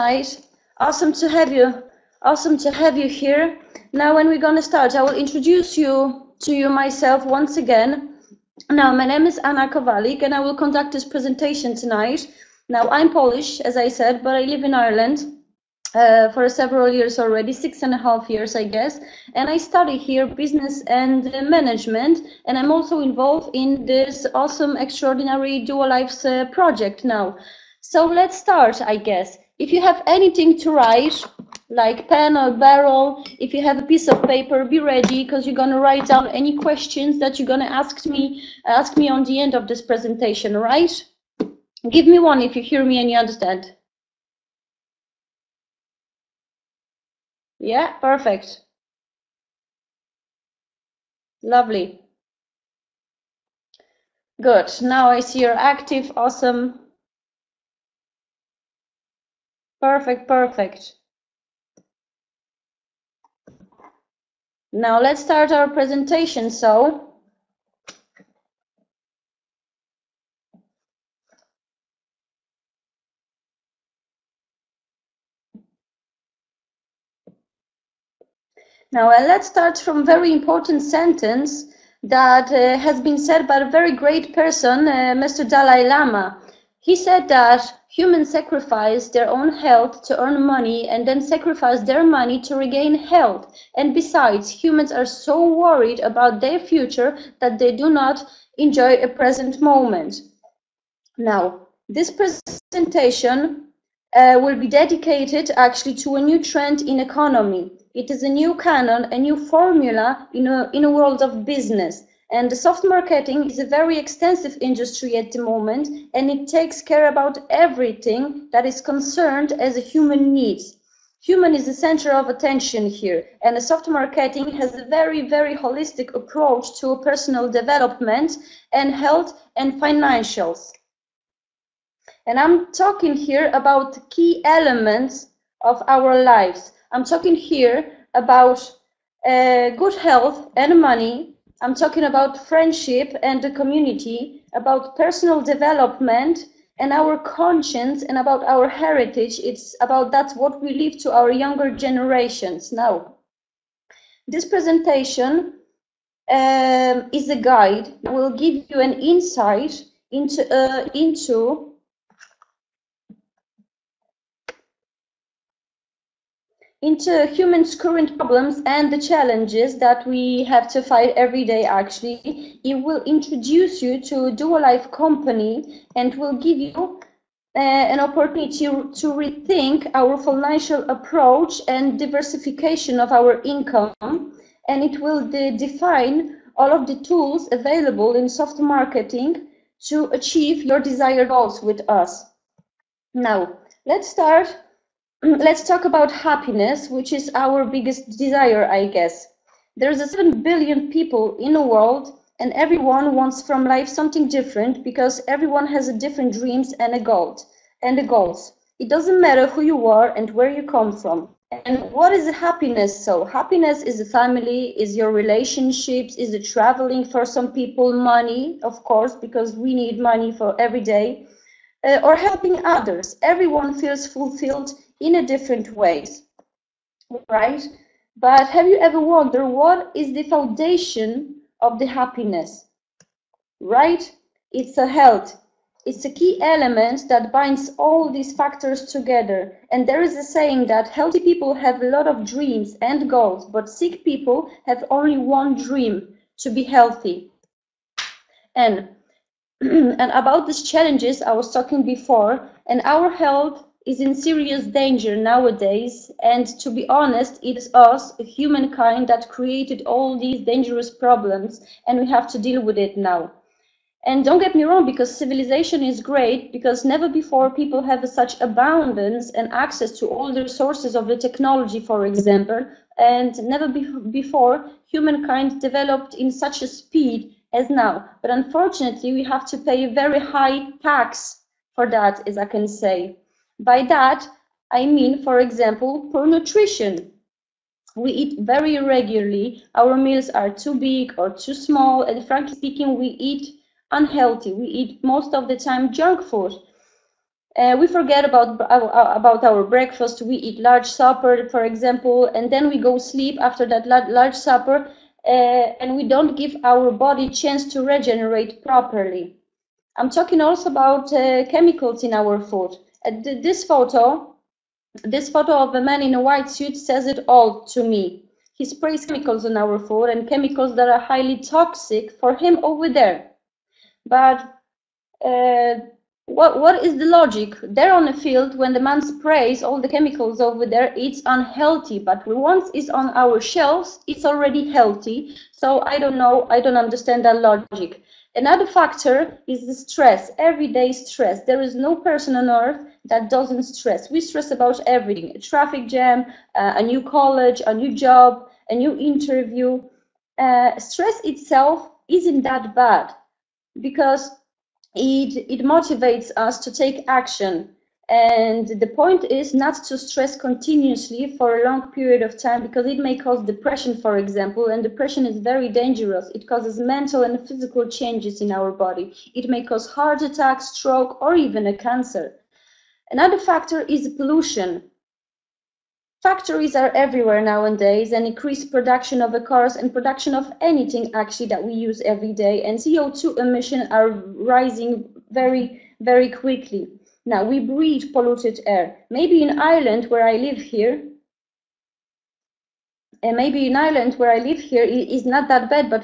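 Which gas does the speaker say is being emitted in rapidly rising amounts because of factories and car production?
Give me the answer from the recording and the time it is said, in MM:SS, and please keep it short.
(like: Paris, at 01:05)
CO2, at 06:22.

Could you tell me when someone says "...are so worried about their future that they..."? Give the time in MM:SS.
01:34.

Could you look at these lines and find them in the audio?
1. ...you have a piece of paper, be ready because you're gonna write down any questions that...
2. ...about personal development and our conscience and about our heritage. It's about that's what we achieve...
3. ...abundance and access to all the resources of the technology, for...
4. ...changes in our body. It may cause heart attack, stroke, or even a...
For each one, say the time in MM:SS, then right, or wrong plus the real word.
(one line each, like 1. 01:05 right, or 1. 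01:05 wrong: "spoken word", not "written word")
1. 00:33 right
2. 02:24 wrong: "leave", not "achieve"
3. 04:28 right
4. 06:07 right.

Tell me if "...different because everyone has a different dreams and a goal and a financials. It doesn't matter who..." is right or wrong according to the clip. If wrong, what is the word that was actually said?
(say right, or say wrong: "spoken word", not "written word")
wrong: "goals", not "financials".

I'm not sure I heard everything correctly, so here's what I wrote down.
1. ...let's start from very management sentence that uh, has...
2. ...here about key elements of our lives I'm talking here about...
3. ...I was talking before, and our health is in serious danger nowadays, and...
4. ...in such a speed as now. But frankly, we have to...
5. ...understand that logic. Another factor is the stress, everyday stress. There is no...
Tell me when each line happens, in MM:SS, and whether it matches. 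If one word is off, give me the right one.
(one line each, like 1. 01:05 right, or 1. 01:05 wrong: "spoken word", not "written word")
1. 01:19 wrong: "important", not "management"
2. 02:13 right
3. 04:11 right
4. 04:36 wrong: "unfortunately", not "frankly"
5. 05:36 right.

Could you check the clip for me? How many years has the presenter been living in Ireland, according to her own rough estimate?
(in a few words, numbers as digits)
6 and a half years.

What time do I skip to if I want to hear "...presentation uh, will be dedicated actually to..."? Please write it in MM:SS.
01:42.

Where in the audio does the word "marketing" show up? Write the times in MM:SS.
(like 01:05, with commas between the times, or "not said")
01:52, 02:03, 03:08.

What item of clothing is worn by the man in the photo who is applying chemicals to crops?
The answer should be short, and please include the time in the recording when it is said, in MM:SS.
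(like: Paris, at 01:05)
white suit, at 05:16.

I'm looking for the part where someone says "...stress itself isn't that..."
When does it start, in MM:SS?
05:50.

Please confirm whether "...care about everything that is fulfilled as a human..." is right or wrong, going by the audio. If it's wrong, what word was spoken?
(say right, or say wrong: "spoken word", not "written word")
wrong: "concerned", not "fulfilled".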